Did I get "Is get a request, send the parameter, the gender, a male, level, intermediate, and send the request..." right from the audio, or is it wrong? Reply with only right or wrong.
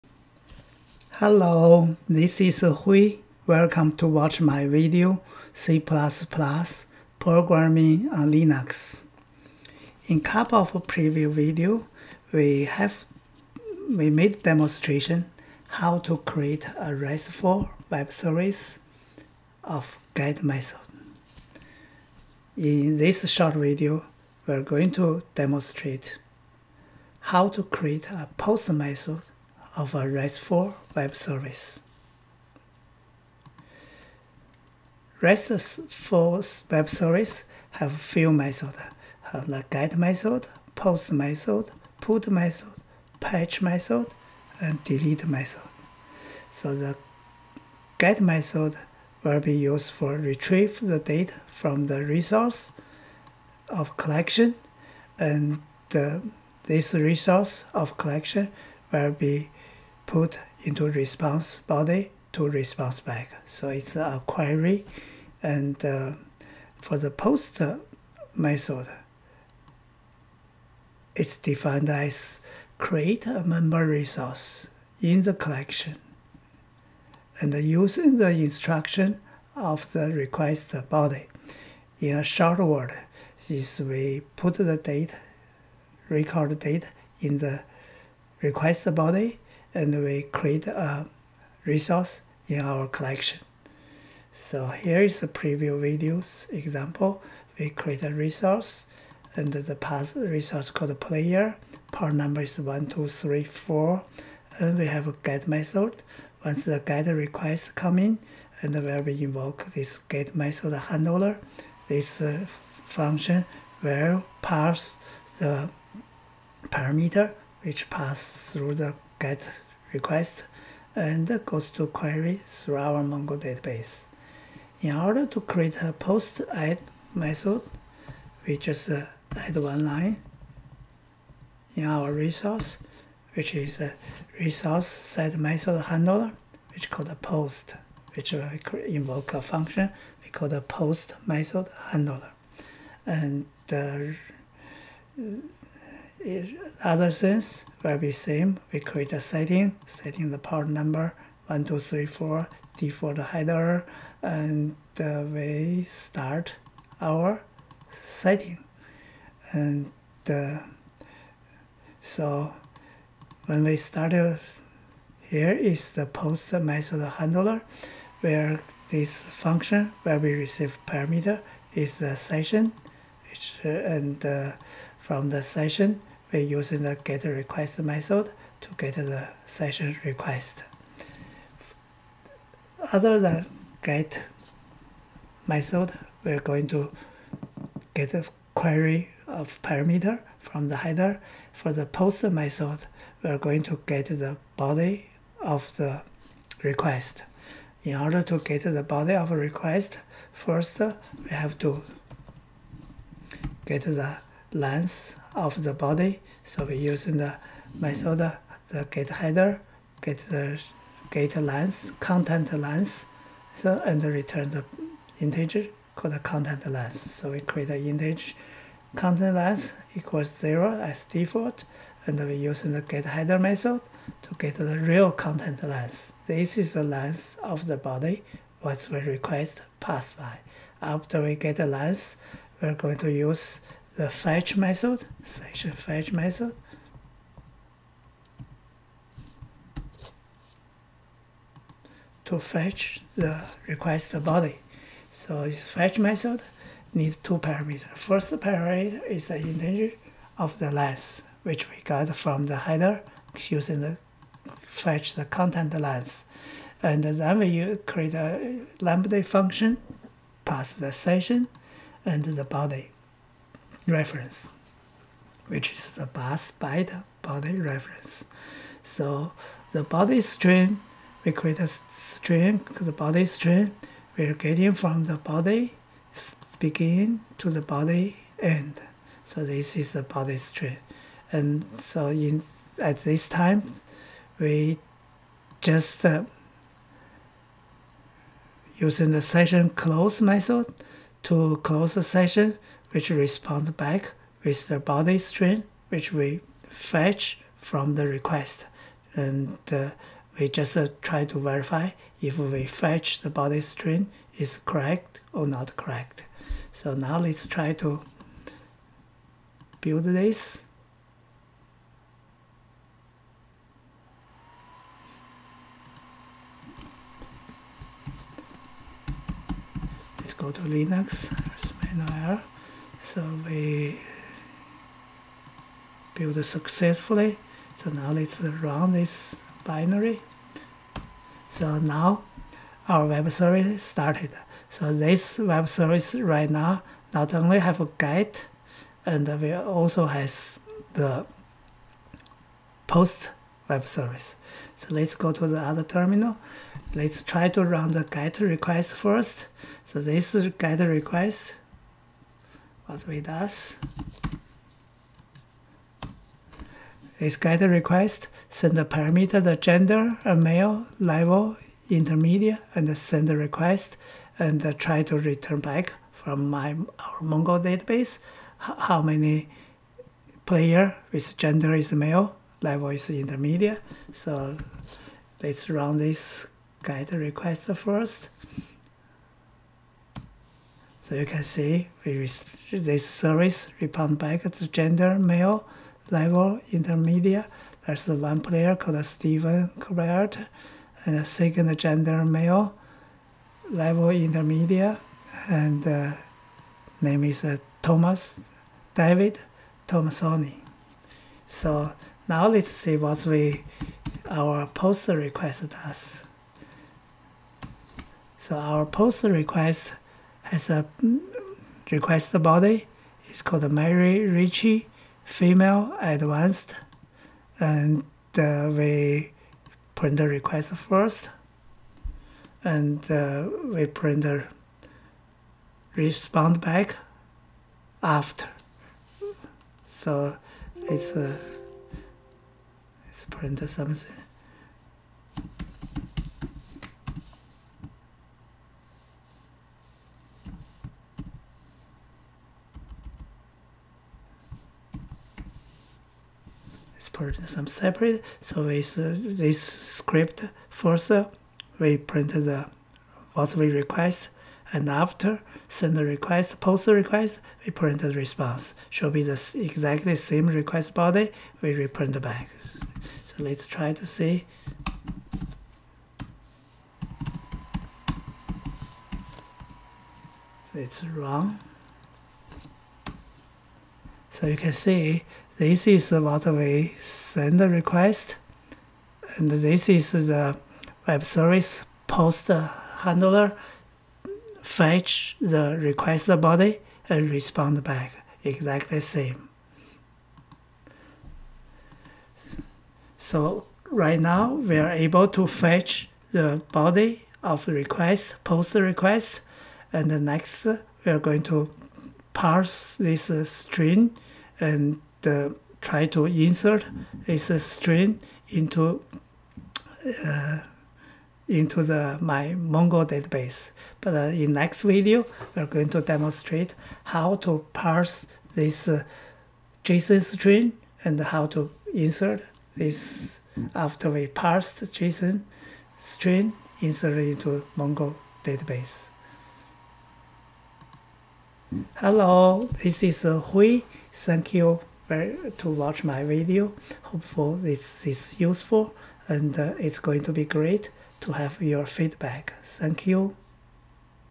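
right.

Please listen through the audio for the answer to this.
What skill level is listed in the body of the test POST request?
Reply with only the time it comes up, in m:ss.
6:56.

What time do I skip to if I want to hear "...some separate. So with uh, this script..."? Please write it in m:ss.
7:27.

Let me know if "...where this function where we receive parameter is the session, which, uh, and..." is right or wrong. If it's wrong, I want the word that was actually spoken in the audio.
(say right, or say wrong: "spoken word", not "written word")
right.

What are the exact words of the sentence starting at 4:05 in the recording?
So fetch method needs two parameters.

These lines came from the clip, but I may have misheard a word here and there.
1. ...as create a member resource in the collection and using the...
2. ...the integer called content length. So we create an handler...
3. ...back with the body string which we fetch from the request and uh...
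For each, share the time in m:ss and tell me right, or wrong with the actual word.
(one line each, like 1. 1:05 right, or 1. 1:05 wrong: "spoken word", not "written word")
1. 1:11 right
2. 3:34 wrong: "integer", not "handler"
3. 4:53 right.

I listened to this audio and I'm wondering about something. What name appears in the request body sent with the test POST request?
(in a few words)
Mary Ritchie.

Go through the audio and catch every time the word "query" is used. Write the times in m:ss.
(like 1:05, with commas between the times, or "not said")
1:04, 2:01, 3:08.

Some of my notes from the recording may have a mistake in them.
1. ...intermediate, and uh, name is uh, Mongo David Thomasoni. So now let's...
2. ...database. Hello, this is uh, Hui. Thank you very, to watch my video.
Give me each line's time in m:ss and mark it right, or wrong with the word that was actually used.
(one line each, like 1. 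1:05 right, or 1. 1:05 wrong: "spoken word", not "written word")
1. 6:34 wrong: "Thomas", not "Mongo"
2. 8:48 right.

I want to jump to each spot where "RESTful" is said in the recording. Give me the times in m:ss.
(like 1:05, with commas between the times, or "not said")
0:16, 0:30, 0:35.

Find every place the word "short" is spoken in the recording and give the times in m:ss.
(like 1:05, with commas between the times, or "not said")
0:23, 1:22.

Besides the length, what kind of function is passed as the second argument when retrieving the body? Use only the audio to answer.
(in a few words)
lambda function.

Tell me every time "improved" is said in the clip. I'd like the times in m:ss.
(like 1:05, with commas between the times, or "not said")
not said.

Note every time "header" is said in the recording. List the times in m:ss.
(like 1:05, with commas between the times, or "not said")
2:33, 3:10, 3:29, 3:43, 4:12.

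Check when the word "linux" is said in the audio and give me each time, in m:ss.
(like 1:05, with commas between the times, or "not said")
0:08, 5:20.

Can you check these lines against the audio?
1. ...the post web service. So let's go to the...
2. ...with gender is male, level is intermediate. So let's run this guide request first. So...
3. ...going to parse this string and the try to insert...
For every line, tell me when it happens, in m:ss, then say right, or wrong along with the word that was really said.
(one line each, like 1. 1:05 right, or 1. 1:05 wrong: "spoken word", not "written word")
1. 5:40 right
2. 6:11 right
3. 8:21 right.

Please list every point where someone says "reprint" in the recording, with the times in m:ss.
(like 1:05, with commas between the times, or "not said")
7:41.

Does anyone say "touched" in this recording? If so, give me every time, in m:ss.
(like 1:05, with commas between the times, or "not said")
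not said.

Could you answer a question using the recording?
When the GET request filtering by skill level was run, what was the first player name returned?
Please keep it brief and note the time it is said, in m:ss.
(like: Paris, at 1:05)
Stephen Colbert, at 6:29.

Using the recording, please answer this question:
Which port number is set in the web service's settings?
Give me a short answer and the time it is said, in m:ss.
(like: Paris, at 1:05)
1234, at 2:31.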